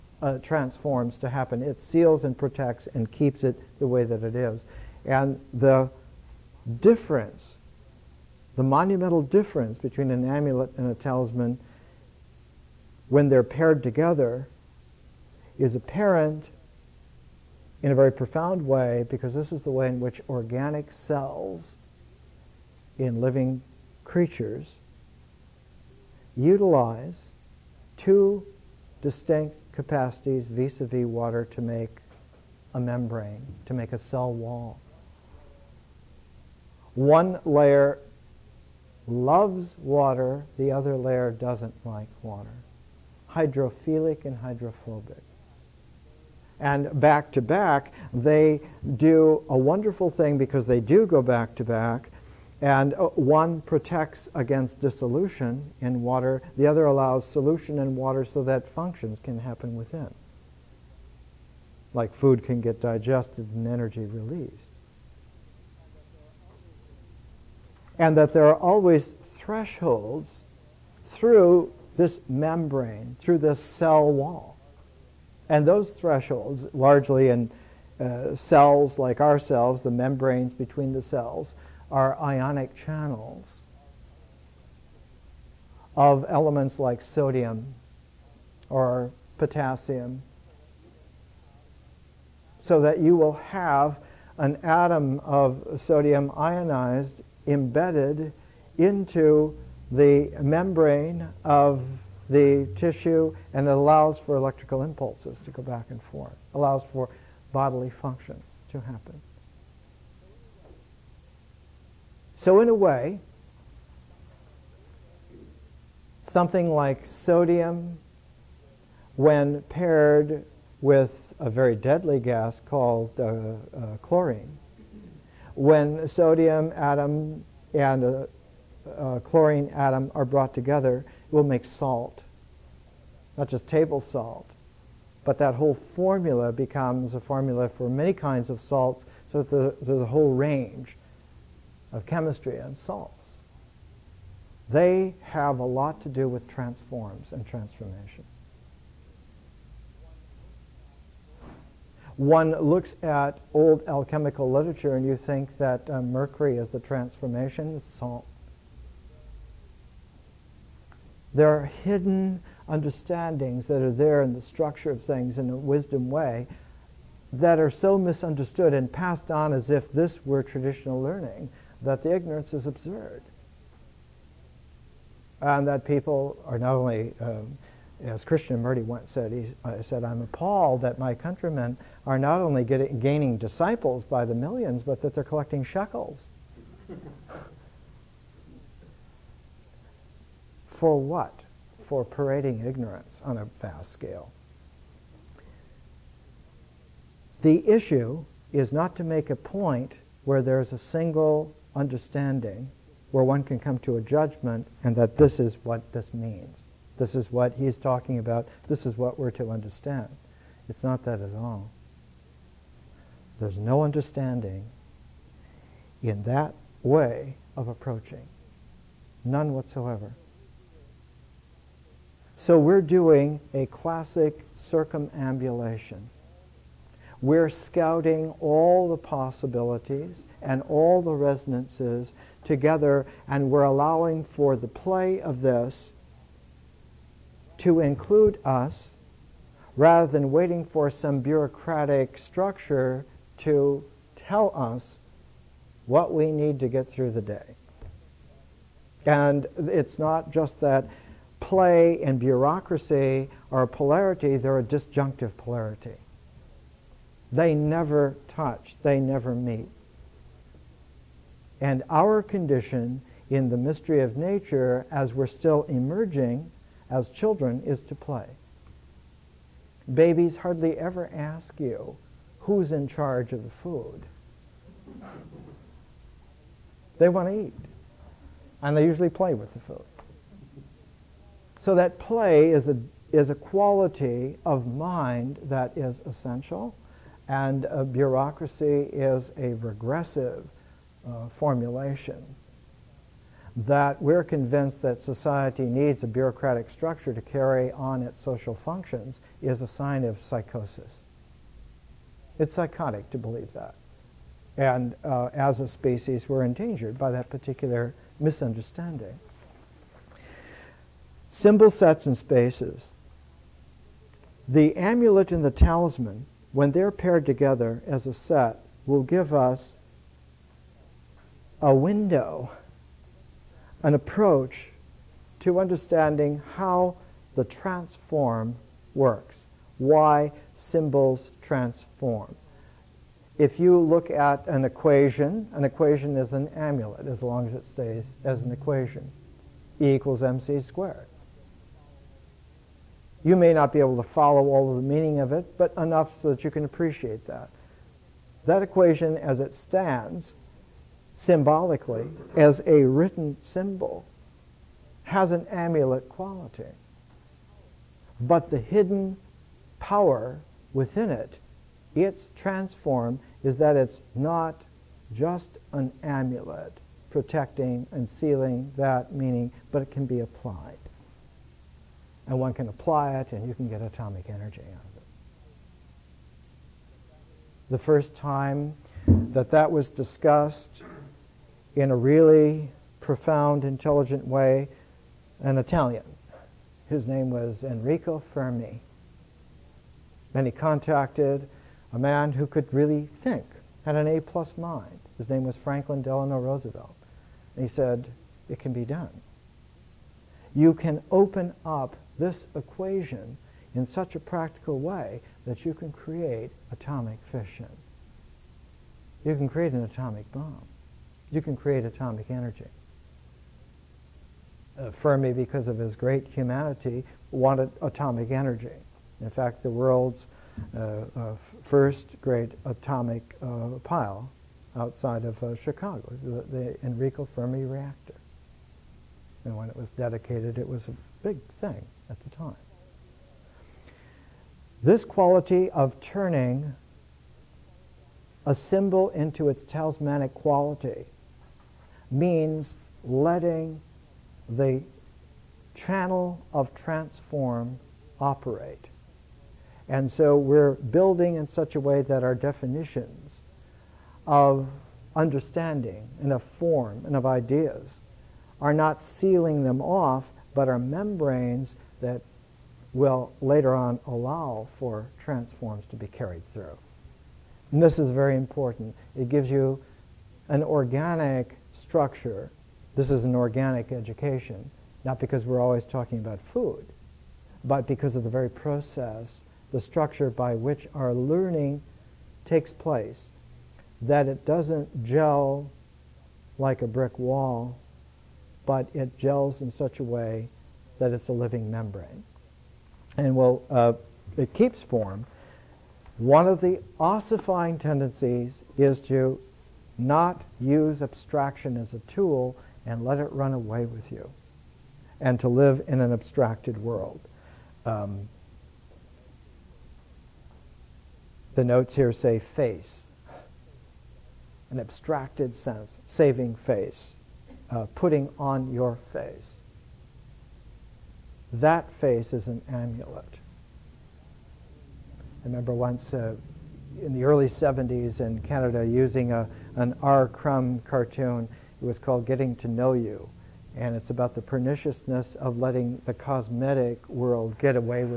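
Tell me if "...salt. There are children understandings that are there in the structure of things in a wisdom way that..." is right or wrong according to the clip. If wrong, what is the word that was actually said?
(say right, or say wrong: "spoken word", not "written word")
wrong: "hidden", not "children".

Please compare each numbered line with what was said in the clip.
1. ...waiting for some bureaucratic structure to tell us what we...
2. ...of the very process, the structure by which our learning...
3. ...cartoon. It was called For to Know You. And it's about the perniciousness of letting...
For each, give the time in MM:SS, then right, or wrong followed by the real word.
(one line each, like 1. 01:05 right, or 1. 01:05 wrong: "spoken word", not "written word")
1. 04:00 right
2. 07:58 right
3. 08:50 wrong: "Getting", not "For".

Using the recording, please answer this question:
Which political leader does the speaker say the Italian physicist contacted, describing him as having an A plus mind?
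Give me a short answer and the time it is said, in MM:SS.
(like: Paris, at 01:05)
Franklin Delano Roosevelt, at 06:35.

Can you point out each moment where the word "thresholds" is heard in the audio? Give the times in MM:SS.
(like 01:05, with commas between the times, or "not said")
01:09, 01:15.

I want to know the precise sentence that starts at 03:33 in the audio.
There's no understanding in that way of approaching.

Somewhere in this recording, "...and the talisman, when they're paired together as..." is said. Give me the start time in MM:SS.
05:15.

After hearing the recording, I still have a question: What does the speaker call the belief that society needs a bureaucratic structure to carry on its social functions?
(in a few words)
psychosis.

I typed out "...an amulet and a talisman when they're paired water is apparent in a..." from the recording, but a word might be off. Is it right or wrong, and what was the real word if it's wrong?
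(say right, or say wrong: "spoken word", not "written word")
wrong: "together", not "water".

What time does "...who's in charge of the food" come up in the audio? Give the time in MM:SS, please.
04:32.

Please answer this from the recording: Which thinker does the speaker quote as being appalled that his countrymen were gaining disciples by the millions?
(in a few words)
Krishnamurti.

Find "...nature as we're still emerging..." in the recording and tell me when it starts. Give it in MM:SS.
04:24.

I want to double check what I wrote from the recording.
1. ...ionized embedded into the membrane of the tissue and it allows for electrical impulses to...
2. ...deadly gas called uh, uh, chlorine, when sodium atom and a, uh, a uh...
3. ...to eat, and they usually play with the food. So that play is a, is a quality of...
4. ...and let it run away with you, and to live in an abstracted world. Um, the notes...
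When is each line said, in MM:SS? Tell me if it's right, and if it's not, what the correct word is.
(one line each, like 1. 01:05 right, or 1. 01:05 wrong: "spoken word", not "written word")
1. 01:36 right
2. 02:01 right
3. 04:37 right
4. 08:22 right.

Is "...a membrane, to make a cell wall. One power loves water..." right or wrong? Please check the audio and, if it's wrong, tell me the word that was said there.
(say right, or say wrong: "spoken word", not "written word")
wrong: "layer", not "power".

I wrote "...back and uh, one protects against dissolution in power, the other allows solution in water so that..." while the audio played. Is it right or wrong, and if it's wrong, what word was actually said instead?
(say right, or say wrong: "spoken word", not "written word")
wrong: "water", not "power".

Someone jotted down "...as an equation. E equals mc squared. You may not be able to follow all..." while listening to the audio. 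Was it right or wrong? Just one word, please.
right.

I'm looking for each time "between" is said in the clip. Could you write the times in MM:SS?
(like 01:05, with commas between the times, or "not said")
00:09, 01:20.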